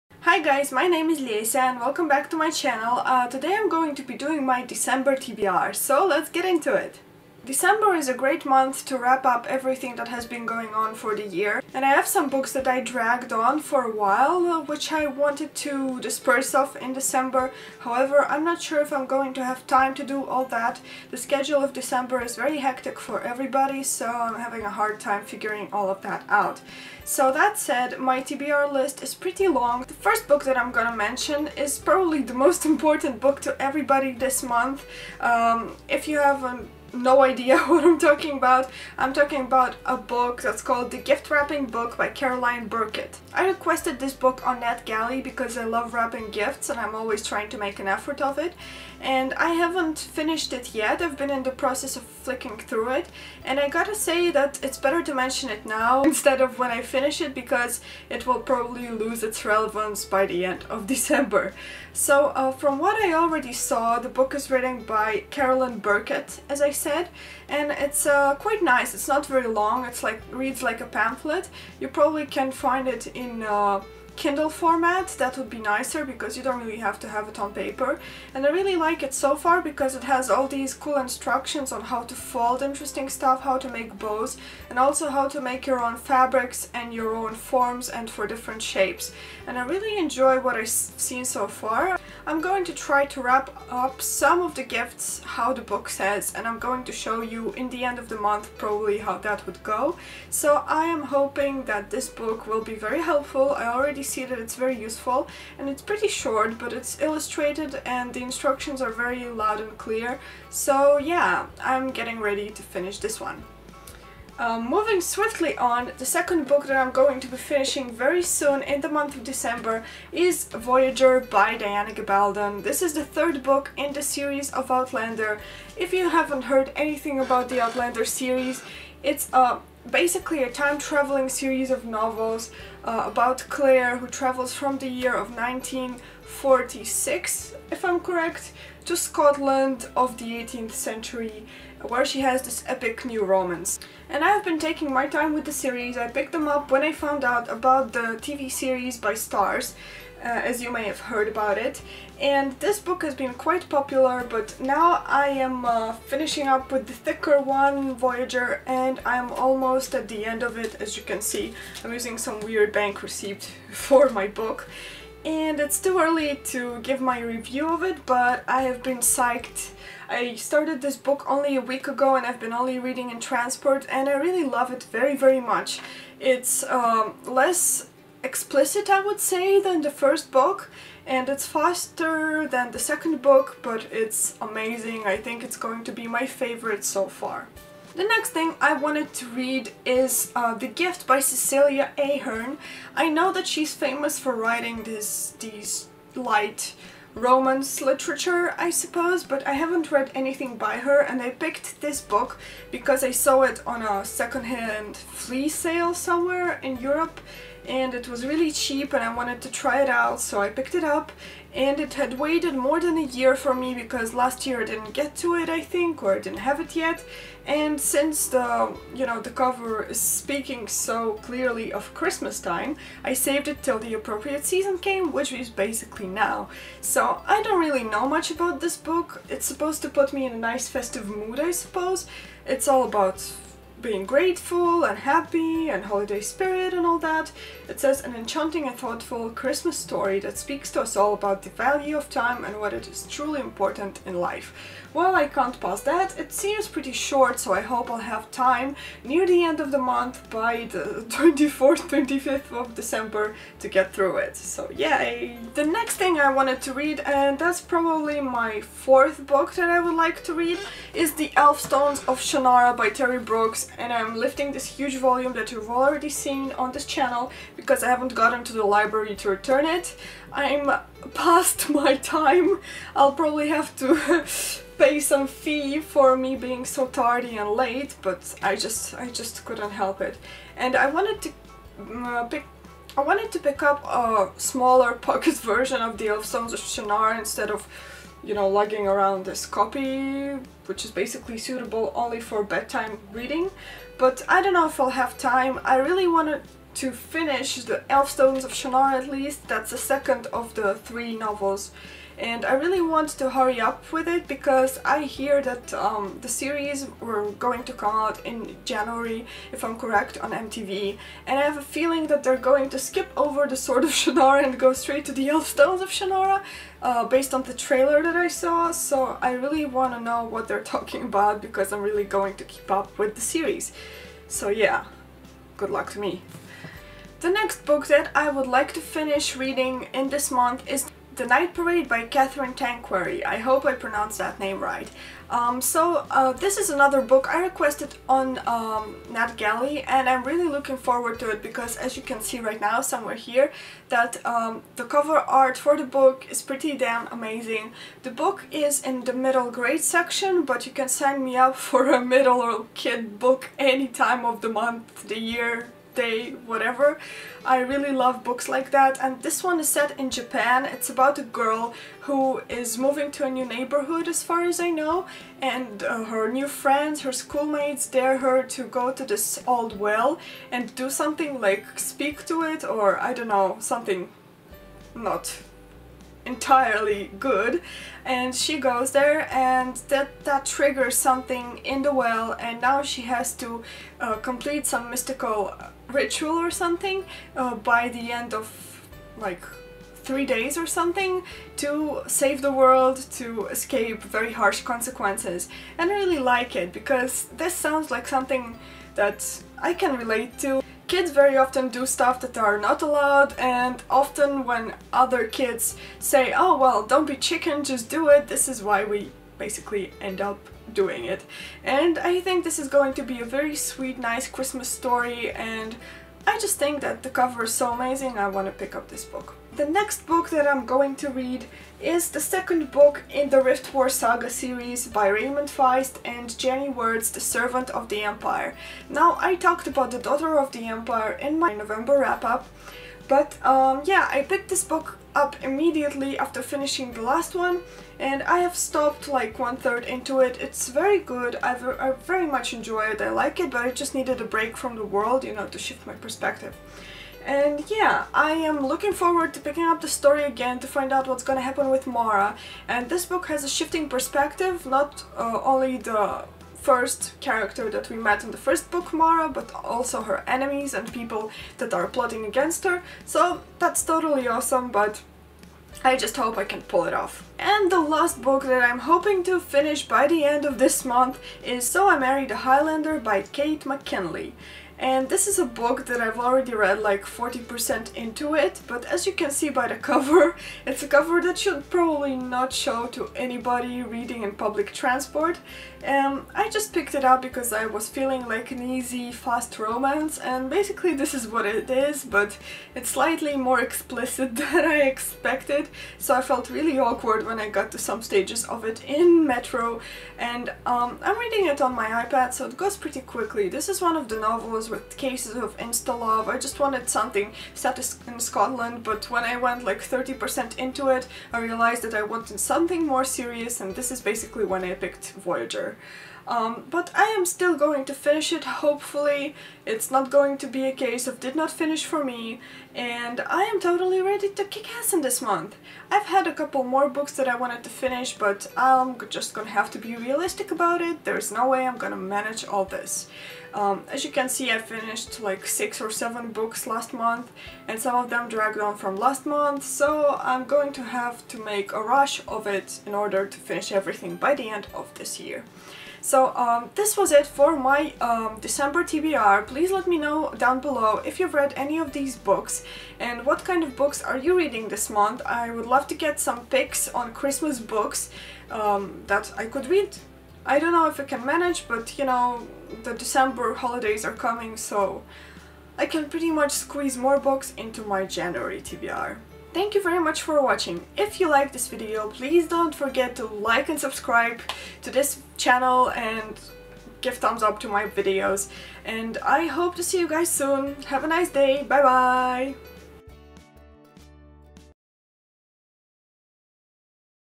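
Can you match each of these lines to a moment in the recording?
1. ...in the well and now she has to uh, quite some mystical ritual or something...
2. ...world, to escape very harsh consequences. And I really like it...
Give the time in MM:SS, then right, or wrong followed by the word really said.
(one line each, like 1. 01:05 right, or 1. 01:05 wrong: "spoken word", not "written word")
1. 06:21 wrong: "complete", not "quite"
2. 06:32 right.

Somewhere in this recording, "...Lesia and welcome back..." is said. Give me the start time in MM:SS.
00:01.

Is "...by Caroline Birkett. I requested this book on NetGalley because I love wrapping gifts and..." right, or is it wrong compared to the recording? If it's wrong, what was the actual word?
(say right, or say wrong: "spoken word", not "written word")
right.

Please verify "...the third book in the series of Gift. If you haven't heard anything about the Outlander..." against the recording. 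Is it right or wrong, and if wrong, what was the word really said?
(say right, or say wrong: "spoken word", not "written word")
wrong: "Outlander", not "Gift".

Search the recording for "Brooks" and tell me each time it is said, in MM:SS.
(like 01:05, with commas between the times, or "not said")
04:23.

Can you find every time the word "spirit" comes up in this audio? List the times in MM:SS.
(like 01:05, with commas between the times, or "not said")
03:56.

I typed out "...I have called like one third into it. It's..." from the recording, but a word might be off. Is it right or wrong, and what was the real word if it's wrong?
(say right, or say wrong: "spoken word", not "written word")
wrong: "stopped", not "called".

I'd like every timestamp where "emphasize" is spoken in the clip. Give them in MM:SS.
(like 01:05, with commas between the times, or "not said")
not said.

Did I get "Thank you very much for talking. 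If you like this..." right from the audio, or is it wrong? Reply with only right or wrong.
wrong.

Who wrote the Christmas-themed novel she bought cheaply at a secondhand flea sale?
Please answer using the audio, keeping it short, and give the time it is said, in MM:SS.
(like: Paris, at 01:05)
Cecelia Ahern, at 03:11.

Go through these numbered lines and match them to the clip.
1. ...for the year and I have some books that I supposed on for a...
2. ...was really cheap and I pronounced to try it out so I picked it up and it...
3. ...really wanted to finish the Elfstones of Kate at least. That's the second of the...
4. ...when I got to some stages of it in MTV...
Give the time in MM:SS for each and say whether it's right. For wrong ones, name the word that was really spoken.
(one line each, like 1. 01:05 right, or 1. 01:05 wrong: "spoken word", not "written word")
1. 00:10 wrong: "dragged", not "supposed"
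2. 03:28 wrong: "wanted", not "pronounced"
3. 04:55 wrong: "Shannara", not "Kate"
4. 08:17 wrong: "Metro", not "MTV".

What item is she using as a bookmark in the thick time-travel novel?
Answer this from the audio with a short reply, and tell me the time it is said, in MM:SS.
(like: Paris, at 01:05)
bank receipt, at 02:42.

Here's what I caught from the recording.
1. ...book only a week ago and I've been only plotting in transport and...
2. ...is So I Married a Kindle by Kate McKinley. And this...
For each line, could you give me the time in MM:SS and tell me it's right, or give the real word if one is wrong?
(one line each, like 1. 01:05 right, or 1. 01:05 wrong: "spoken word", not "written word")
1. 02:50 wrong: "reading", not "plotting"
2. 07:51 wrong: "Highlander", not "Kindle".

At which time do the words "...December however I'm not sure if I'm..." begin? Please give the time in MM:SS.
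00:16.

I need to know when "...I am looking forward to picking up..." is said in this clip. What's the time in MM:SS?
07:28.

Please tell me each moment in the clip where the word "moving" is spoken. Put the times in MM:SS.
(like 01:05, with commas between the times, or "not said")
01:54, 06:02.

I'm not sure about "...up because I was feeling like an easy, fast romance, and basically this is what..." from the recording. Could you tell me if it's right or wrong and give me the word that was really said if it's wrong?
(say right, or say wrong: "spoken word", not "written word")
right.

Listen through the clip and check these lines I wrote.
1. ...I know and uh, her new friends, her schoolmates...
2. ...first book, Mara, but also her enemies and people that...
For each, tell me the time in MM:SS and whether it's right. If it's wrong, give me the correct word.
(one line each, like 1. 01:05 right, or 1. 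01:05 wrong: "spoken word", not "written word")
1. 06:04 right
2. 07:38 right.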